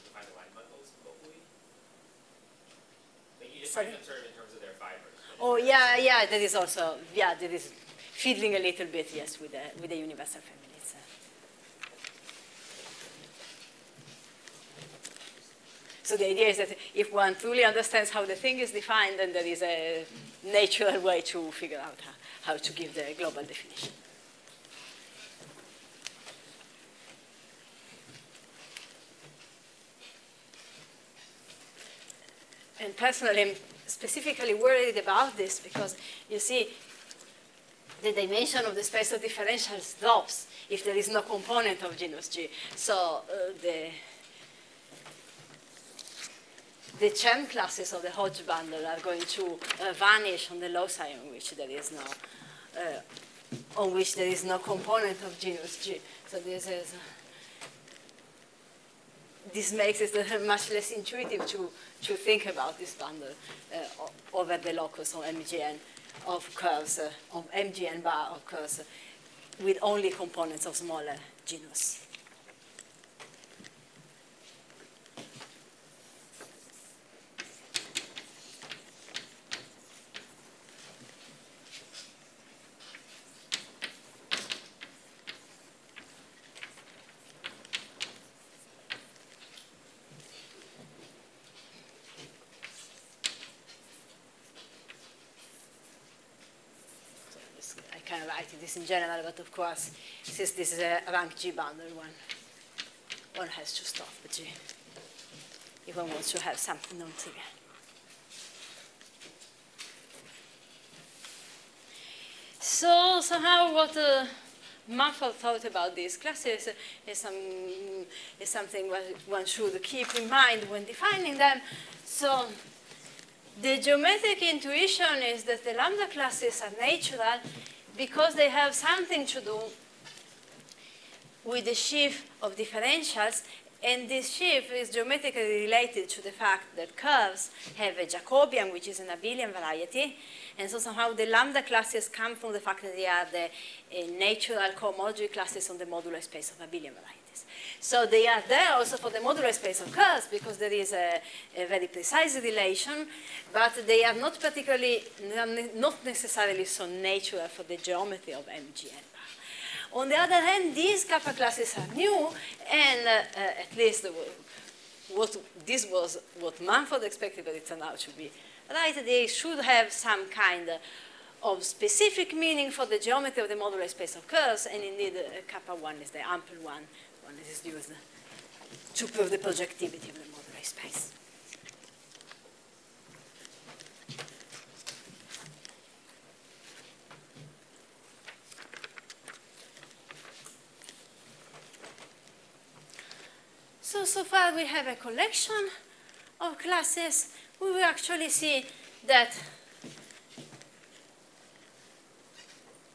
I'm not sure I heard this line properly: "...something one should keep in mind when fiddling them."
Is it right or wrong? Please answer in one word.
wrong.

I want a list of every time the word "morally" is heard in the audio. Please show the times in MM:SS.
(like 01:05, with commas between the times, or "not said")
not said.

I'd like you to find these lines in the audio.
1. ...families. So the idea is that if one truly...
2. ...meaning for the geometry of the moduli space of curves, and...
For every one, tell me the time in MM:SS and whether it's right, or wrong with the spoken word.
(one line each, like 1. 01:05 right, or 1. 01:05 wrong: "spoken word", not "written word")
1. 00:10 right
2. 02:52 right.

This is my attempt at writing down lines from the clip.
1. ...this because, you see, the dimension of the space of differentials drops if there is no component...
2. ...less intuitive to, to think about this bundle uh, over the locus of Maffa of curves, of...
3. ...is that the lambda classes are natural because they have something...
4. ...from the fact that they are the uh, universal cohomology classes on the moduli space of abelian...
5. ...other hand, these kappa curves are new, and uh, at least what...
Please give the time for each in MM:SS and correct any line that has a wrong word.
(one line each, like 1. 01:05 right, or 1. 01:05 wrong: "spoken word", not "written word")
1. 00:35 right
2. 01:00 wrong: "MGN", not "Maffa"
3. 02:05 right
4. 02:22 wrong: "natural", not "universal"
5. 02:40 wrong: "classes", not "curves".